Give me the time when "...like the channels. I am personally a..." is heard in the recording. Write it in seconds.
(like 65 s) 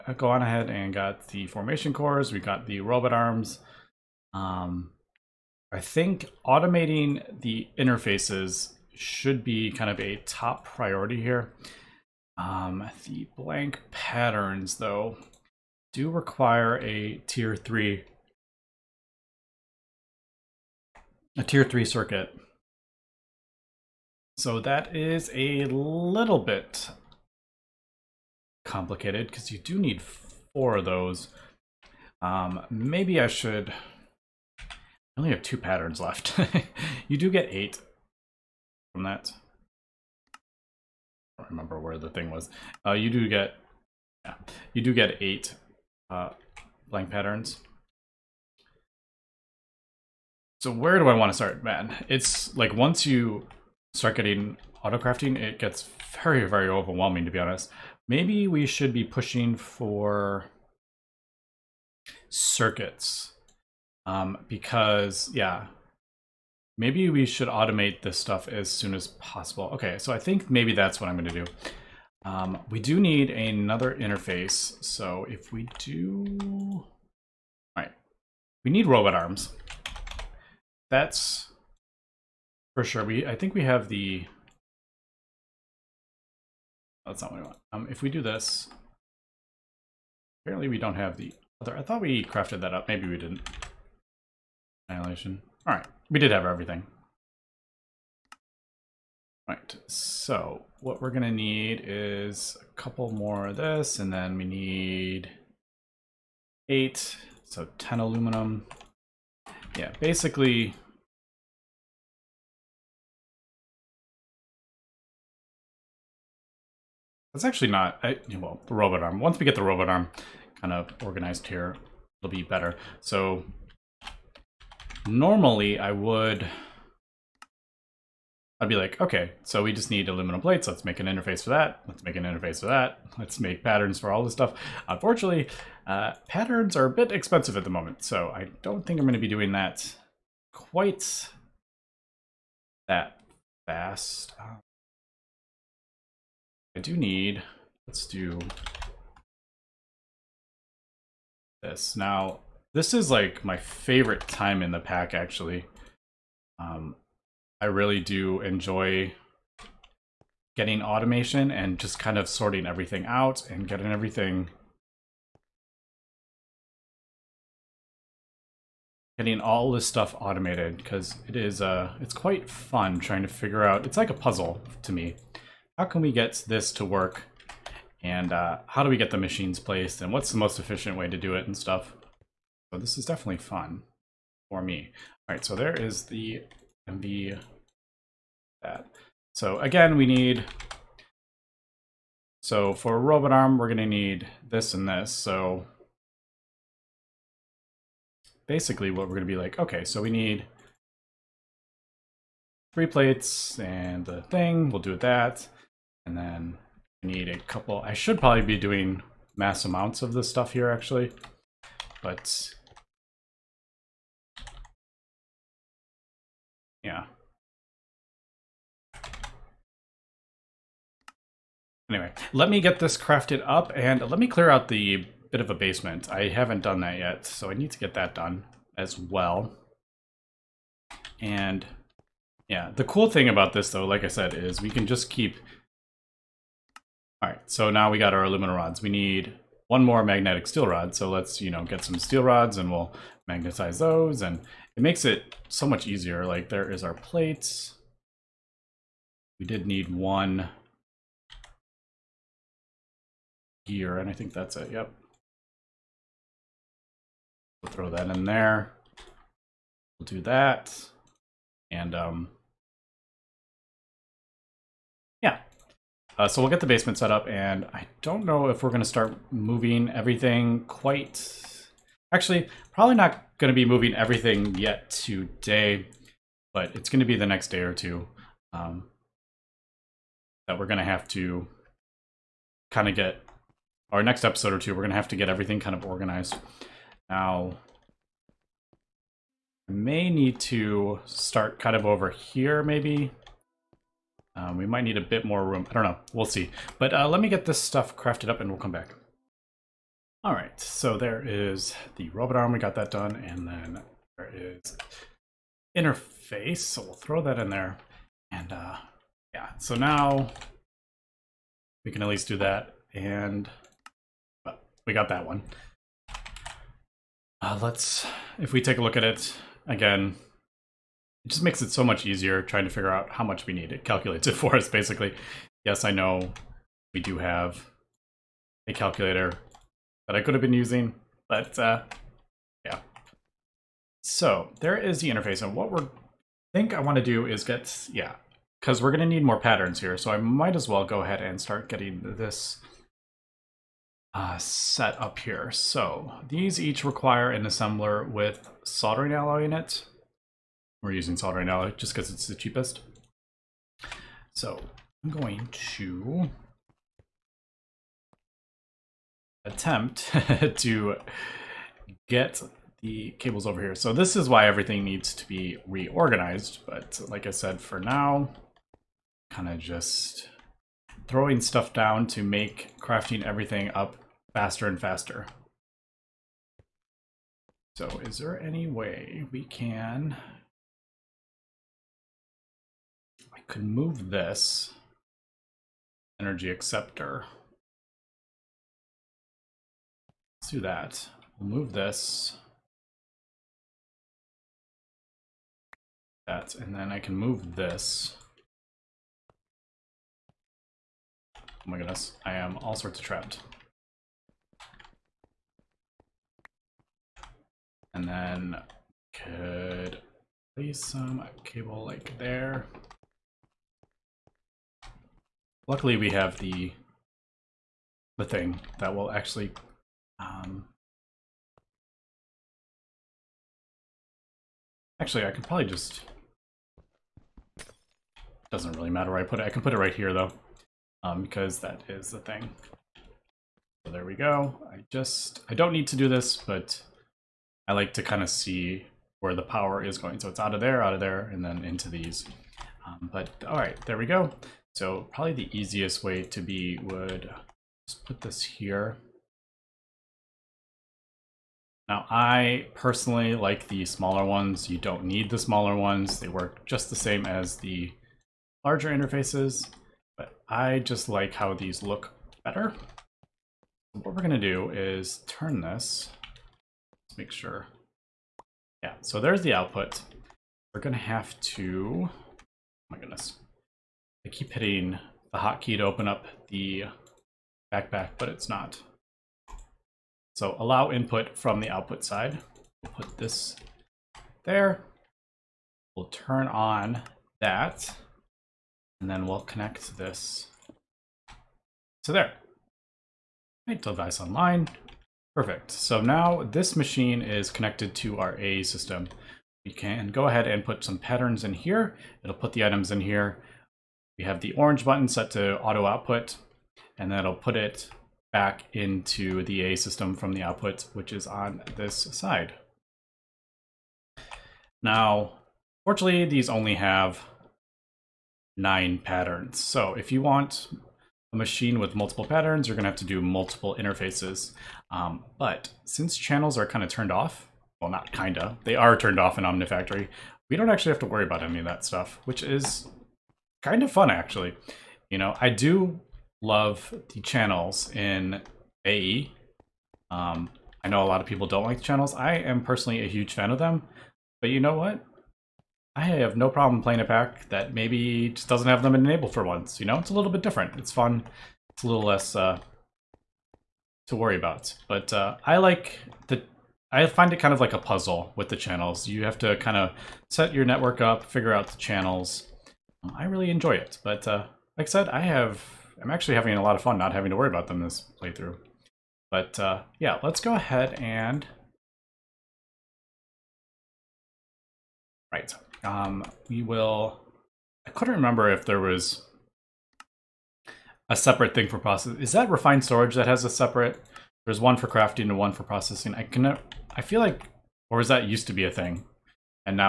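541 s.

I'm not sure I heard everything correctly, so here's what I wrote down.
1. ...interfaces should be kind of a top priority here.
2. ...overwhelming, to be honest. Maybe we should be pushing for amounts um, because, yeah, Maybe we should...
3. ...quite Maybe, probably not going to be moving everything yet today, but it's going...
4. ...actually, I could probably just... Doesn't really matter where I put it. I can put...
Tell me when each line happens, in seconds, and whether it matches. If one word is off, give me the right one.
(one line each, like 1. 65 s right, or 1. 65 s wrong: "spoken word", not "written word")
1. 7 s right
2. 56 s wrong: "circuits", not "amounts"
3. 270 s wrong: "Actually", not "Maybe"
4. 424 s right.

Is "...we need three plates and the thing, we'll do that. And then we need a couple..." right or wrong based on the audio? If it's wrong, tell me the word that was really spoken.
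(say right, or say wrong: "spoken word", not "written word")
right.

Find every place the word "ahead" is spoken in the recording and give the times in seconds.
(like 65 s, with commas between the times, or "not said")
0 s, 341 s, 500 s, 570 s.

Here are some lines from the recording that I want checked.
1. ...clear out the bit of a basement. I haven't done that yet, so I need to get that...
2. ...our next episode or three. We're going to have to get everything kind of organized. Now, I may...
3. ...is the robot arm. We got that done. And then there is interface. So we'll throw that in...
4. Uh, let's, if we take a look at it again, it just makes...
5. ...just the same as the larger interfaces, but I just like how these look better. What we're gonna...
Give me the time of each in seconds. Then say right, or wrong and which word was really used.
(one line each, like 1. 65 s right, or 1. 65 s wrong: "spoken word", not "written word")
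1. 224 s right
2. 283 s wrong: "two", not "three"
3. 301 s right
4. 317 s right
5. 456 s right.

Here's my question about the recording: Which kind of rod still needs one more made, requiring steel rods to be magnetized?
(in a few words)
magnetic steel rod.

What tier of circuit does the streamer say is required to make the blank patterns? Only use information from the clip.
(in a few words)
tier 3.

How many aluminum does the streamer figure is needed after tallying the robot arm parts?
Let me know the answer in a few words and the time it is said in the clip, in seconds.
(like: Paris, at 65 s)
10, at 107 s.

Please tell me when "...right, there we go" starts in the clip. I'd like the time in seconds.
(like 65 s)
443 s.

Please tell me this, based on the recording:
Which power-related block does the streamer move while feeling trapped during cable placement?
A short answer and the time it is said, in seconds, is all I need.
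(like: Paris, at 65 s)
energy acceptor, at 386 s.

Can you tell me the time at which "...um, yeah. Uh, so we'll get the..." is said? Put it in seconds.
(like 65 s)
261 s.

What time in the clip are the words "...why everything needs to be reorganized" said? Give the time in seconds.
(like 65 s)
364 s.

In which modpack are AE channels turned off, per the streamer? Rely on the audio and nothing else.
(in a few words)
Omnifactory.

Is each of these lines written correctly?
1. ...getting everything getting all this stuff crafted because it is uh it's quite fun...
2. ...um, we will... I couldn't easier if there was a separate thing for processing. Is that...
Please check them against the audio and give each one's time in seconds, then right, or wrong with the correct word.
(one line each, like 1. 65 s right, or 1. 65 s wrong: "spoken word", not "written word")
1. 163 s wrong: "automated", not "crafted"
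2. 575 s wrong: "remember", not "easier".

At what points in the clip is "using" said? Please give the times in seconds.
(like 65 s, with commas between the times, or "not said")
330 s, 350 s.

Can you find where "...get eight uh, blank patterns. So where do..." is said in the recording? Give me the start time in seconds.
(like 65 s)
44 s.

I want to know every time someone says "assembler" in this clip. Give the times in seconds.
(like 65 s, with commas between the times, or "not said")
347 s.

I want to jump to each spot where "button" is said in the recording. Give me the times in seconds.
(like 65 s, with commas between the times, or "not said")
504 s.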